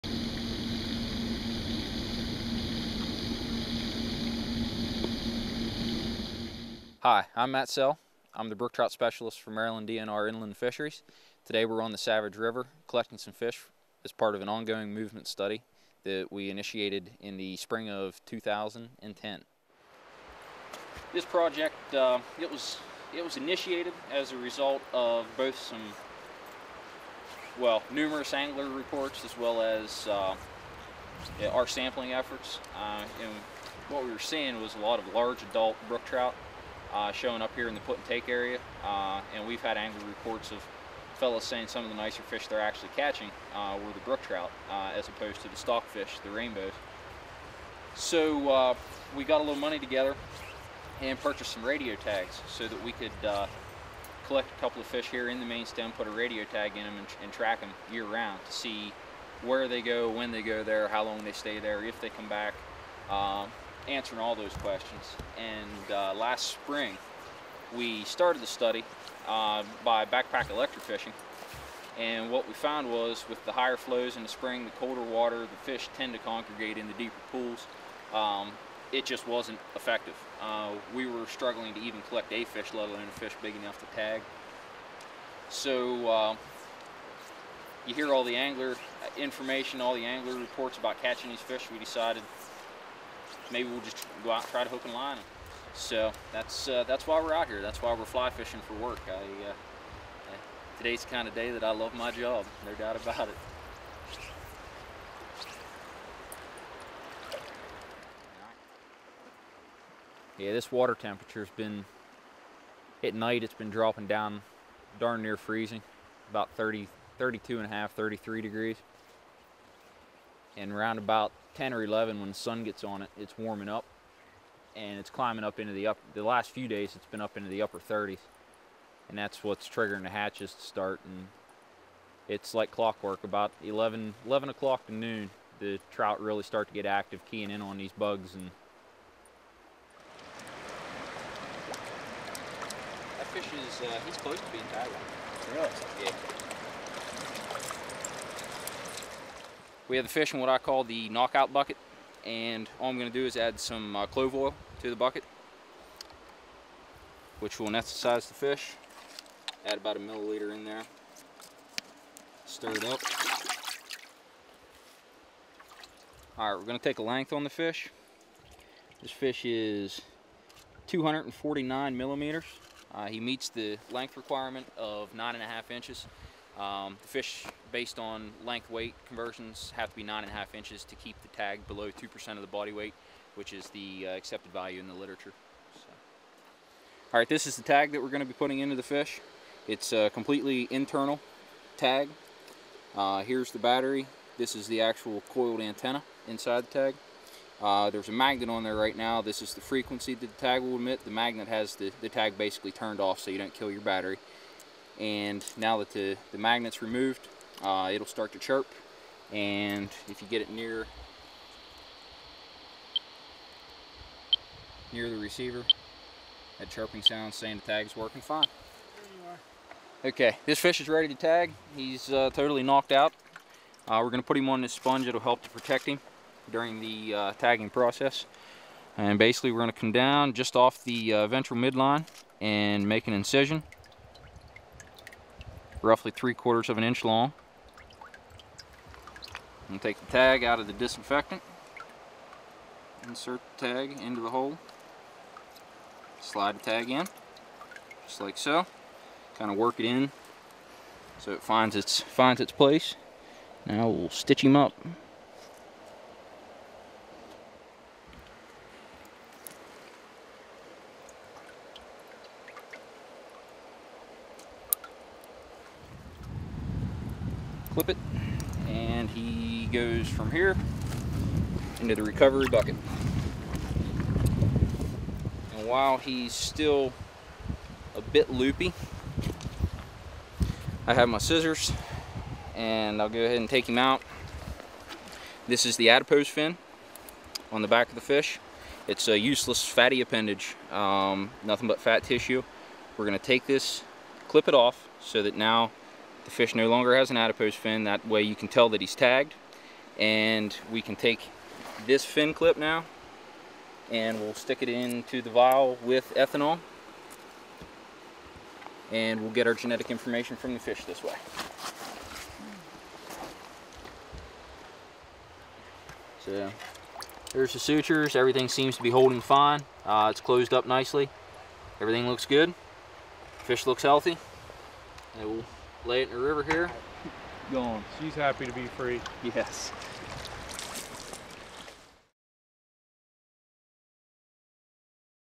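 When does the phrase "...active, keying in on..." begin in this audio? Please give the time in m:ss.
2:16.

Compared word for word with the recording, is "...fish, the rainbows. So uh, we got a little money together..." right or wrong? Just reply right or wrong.
right.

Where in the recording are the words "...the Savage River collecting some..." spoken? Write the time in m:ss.
0:11.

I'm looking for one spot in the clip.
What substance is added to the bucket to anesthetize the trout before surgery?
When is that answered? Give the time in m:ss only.
2:34.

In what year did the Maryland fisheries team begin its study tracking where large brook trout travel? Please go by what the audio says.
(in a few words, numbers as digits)
2010.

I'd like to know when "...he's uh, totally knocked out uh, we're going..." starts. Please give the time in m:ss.
3:41.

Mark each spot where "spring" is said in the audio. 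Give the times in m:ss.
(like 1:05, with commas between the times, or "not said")
0:17, 1:06, 1:14.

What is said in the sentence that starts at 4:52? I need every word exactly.
We're gonna take this, clip it off, so that now the fish no longer has an adipose fin.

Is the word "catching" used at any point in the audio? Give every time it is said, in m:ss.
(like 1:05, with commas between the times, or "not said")
0:42, 1:31.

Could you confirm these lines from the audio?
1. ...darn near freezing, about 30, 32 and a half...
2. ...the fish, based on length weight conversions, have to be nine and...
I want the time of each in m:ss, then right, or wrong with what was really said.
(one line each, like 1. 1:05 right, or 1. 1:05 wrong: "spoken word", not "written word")
1. 1:54 right
2. 2:57 right.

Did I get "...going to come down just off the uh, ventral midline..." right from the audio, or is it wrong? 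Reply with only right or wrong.
right.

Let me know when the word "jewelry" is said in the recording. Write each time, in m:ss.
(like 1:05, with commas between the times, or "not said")
not said.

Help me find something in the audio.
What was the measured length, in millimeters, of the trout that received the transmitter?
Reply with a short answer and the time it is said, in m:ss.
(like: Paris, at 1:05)
249, at 2:50.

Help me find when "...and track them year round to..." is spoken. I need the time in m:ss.
0:57.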